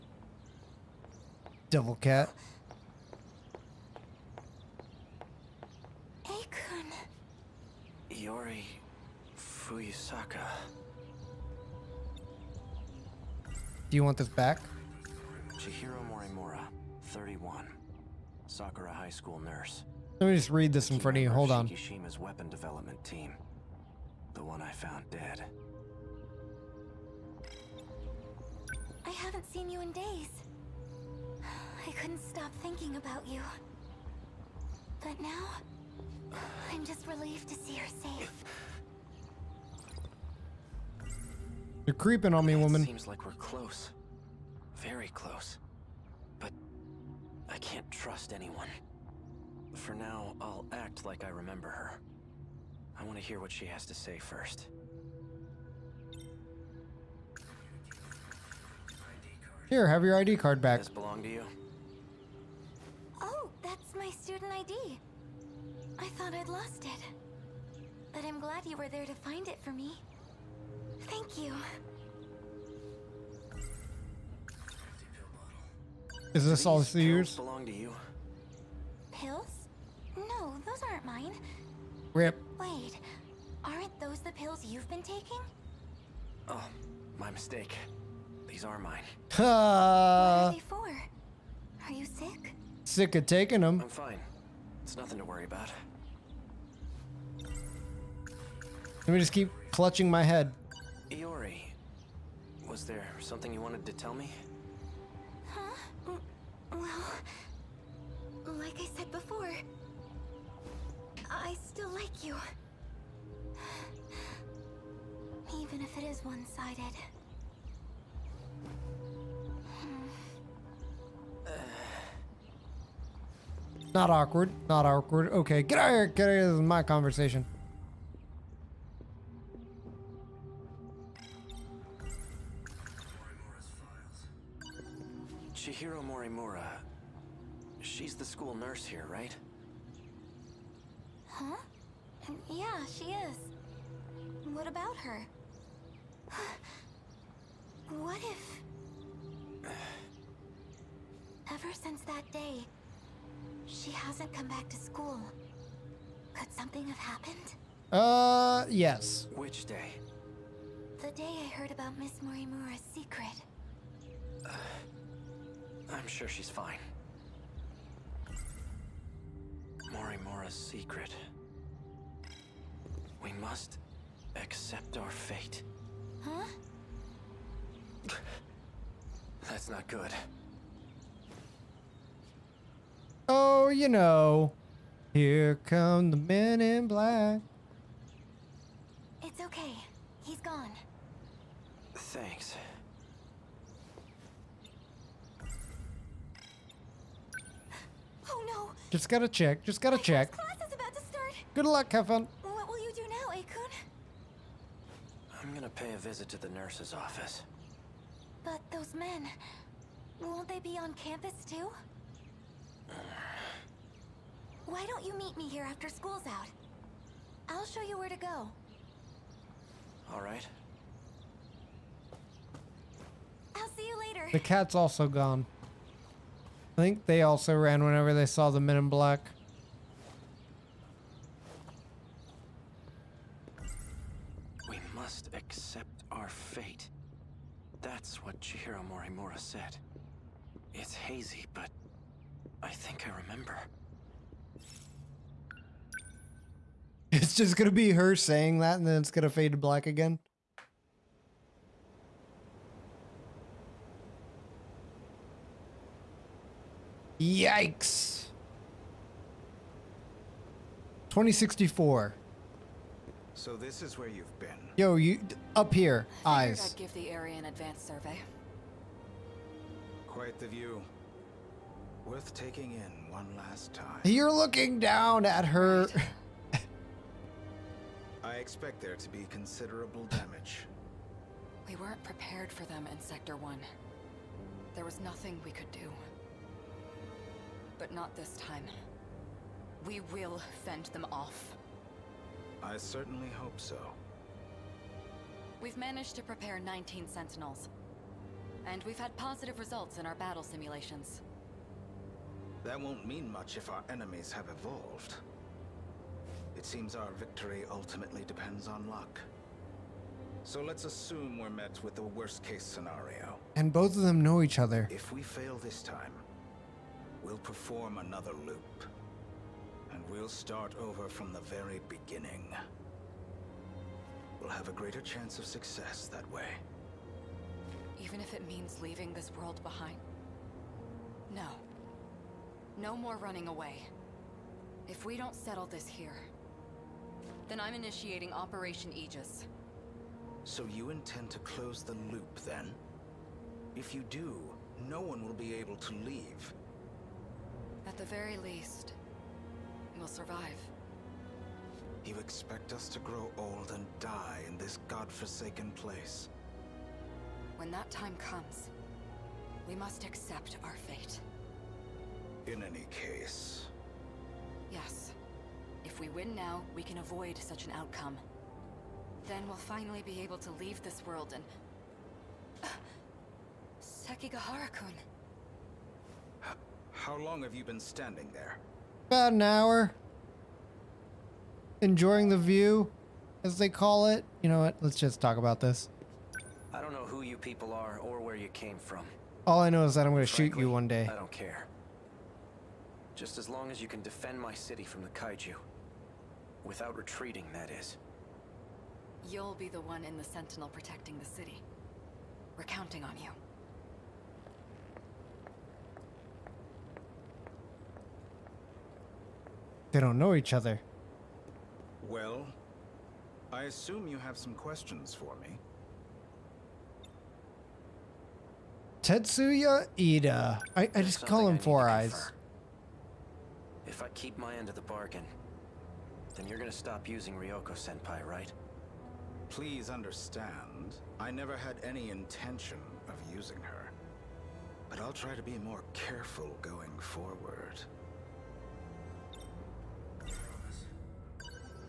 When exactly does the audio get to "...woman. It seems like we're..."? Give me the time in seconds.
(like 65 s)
42 s.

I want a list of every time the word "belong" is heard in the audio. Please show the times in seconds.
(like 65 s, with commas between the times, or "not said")
60 s, 77 s.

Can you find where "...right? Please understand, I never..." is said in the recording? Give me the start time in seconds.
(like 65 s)
428 s.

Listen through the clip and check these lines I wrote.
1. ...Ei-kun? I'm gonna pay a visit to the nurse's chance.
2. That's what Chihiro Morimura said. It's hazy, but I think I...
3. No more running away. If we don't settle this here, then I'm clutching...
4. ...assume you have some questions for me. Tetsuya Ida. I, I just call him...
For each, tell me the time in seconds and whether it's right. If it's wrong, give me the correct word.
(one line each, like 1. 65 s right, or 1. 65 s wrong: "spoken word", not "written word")
1. 203 s wrong: "office", not "chance"
2. 237 s right
3. 332 s wrong: "initiating", not "clutching"
4. 413 s right.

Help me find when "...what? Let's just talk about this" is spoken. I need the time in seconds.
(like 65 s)
384 s.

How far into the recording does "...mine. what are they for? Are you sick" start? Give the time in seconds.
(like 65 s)
88 s.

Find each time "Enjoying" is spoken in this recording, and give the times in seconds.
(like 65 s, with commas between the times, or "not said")
381 s.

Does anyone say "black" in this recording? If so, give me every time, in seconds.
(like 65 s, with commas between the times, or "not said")
186 s, 228 s, 249 s.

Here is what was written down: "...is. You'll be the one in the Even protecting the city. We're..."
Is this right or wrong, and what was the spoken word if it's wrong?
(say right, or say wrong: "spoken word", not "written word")
wrong: "Sentinel", not "Even".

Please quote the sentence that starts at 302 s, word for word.
That won't mean much if our enemies have evolved.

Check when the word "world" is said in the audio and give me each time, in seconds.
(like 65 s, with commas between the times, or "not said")
329 s, 371 s.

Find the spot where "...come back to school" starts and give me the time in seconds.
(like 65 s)
154 s.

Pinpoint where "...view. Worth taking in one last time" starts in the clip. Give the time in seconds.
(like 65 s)
270 s.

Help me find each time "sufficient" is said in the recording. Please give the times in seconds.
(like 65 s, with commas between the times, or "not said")
not said.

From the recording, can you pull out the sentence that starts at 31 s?
I couldn't stop thinking about you.